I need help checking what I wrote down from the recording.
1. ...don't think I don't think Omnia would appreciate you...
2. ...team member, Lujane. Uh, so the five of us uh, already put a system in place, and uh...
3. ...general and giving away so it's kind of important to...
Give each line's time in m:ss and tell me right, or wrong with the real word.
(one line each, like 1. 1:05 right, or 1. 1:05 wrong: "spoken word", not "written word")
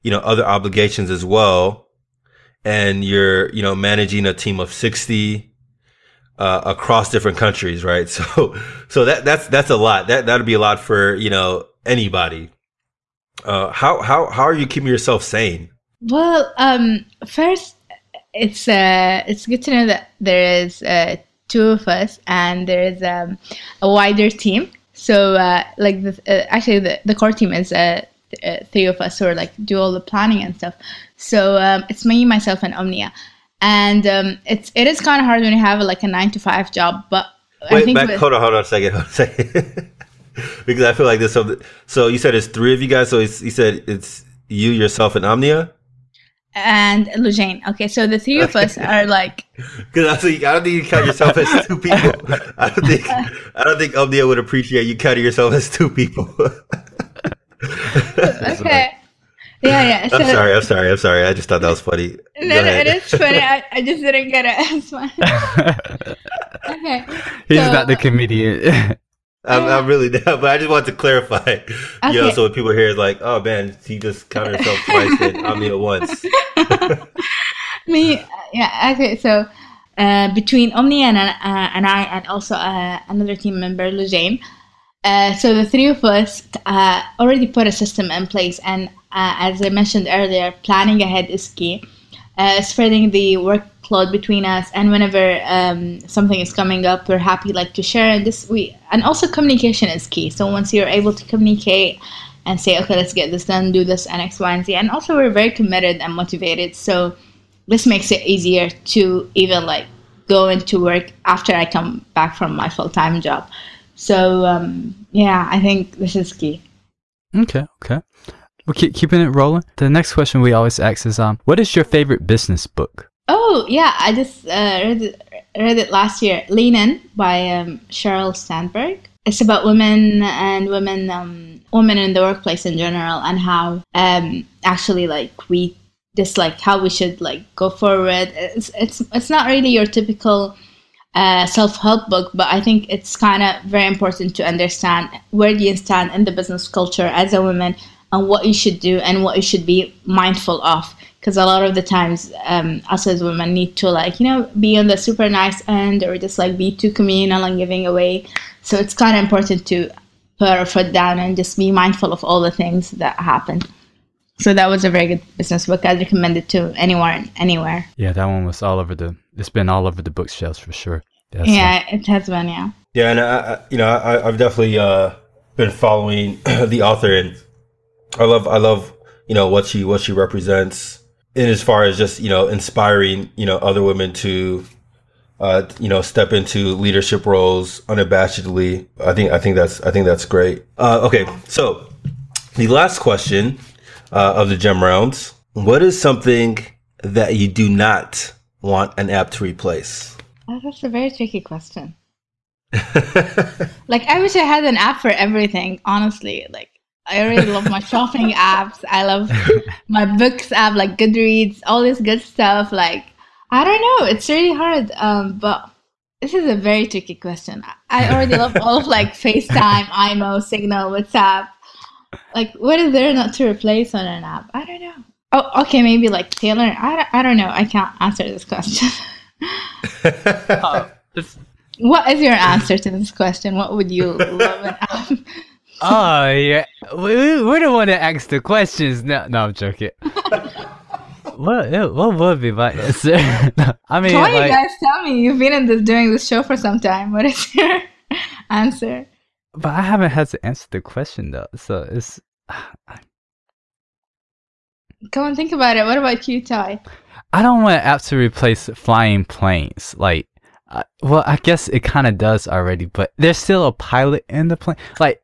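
1. 0:52 right
2. 1:23 wrong: "three", not "five"
3. 2:36 wrong: "communal", not "general".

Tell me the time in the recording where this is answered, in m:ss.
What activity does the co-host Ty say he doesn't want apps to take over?
4:18.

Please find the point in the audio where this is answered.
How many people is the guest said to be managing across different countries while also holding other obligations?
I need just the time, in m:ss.
0:04.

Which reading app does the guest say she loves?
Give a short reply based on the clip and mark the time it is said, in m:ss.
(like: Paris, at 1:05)
Goodreads, at 3:30.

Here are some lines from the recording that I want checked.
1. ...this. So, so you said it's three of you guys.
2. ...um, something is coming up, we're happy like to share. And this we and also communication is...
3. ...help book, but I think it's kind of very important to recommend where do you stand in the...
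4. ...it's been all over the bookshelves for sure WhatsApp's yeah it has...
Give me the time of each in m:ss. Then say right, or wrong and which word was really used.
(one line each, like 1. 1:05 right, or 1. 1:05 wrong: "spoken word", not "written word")
1. 0:41 right
2. 1:35 right
3. 2:21 wrong: "understand", not "recommend"
4. 2:49 wrong: "That", not "WhatsApp".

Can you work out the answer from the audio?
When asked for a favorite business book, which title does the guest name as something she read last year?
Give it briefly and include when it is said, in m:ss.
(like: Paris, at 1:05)
Lean In, at 2:06.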